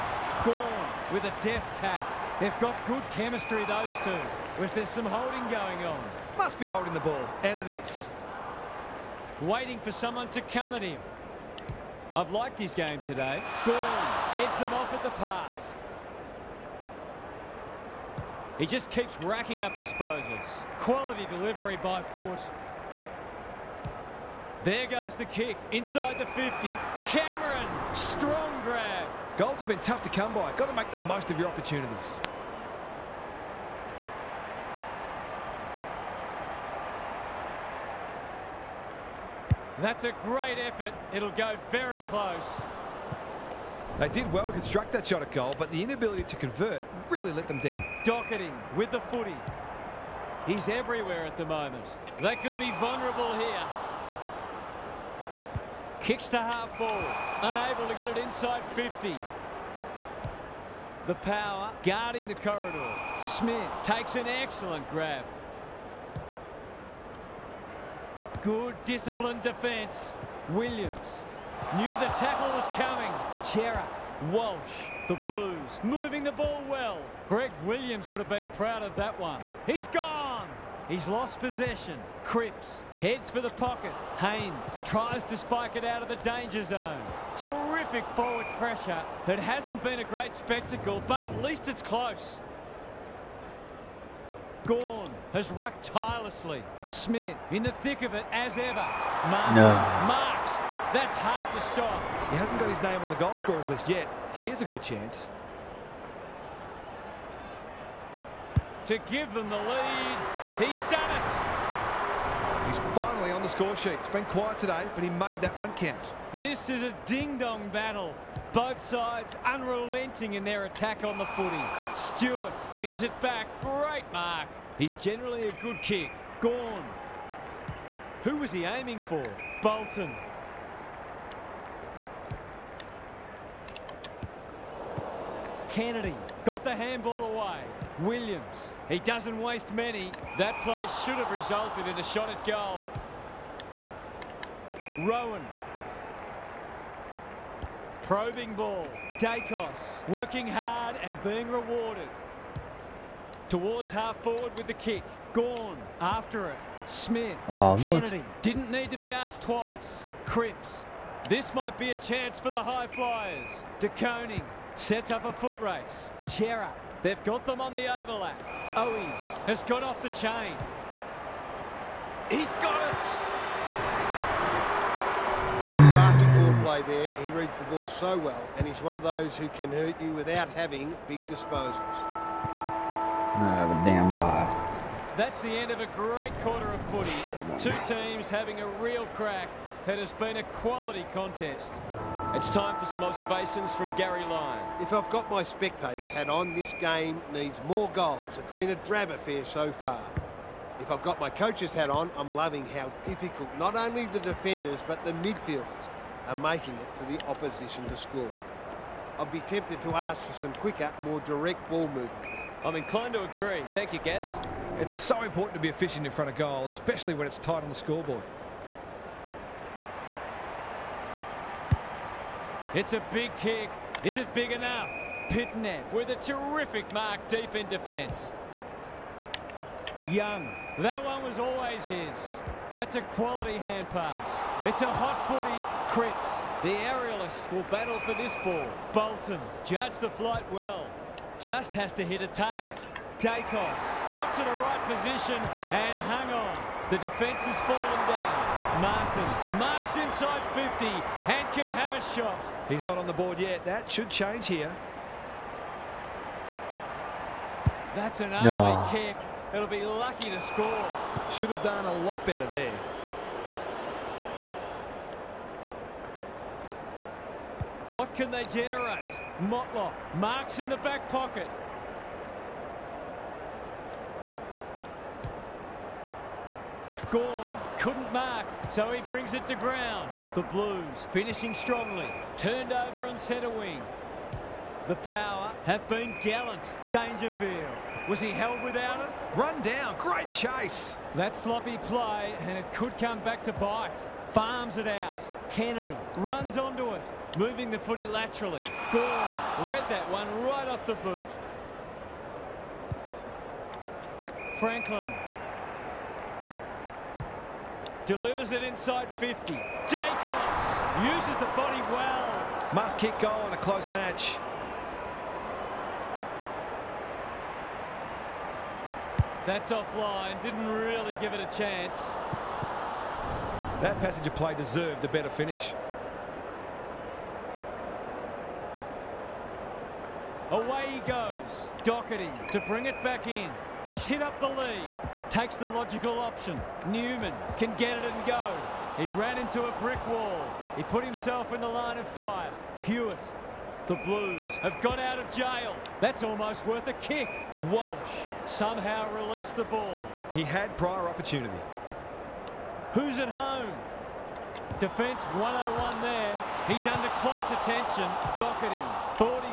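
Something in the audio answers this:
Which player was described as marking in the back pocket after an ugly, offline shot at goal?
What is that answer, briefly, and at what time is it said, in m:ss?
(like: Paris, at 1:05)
Motlop, at 4:29.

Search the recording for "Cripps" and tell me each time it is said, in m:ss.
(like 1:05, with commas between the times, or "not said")
1:22, 2:40, 3:55.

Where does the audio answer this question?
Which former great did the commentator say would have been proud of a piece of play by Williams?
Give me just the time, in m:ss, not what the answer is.
1:17.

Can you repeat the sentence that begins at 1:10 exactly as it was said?
Williams knew the tackle was coming.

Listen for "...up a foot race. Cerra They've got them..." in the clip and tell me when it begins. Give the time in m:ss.
2:45.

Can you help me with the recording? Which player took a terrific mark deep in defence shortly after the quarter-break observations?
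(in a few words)
Pittonet.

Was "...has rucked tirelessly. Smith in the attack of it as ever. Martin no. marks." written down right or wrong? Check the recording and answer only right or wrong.
wrong.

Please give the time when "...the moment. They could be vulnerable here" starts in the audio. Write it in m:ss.
0:51.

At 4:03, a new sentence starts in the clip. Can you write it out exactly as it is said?
Dacos got to the right position and hung on.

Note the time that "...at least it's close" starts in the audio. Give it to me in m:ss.
1:31.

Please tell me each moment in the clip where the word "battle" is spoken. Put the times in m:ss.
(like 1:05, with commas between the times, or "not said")
1:57, 3:57.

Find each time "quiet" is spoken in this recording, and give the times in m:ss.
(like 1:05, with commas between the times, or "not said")
1:54.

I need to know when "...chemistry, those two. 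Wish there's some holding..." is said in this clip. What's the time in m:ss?
0:03.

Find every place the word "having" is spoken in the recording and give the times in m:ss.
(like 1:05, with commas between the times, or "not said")
3:00, 3:08.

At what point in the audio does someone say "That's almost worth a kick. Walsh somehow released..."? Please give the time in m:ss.
5:46.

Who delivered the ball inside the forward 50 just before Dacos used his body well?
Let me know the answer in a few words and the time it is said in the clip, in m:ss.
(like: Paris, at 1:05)
Franklin, at 5:04.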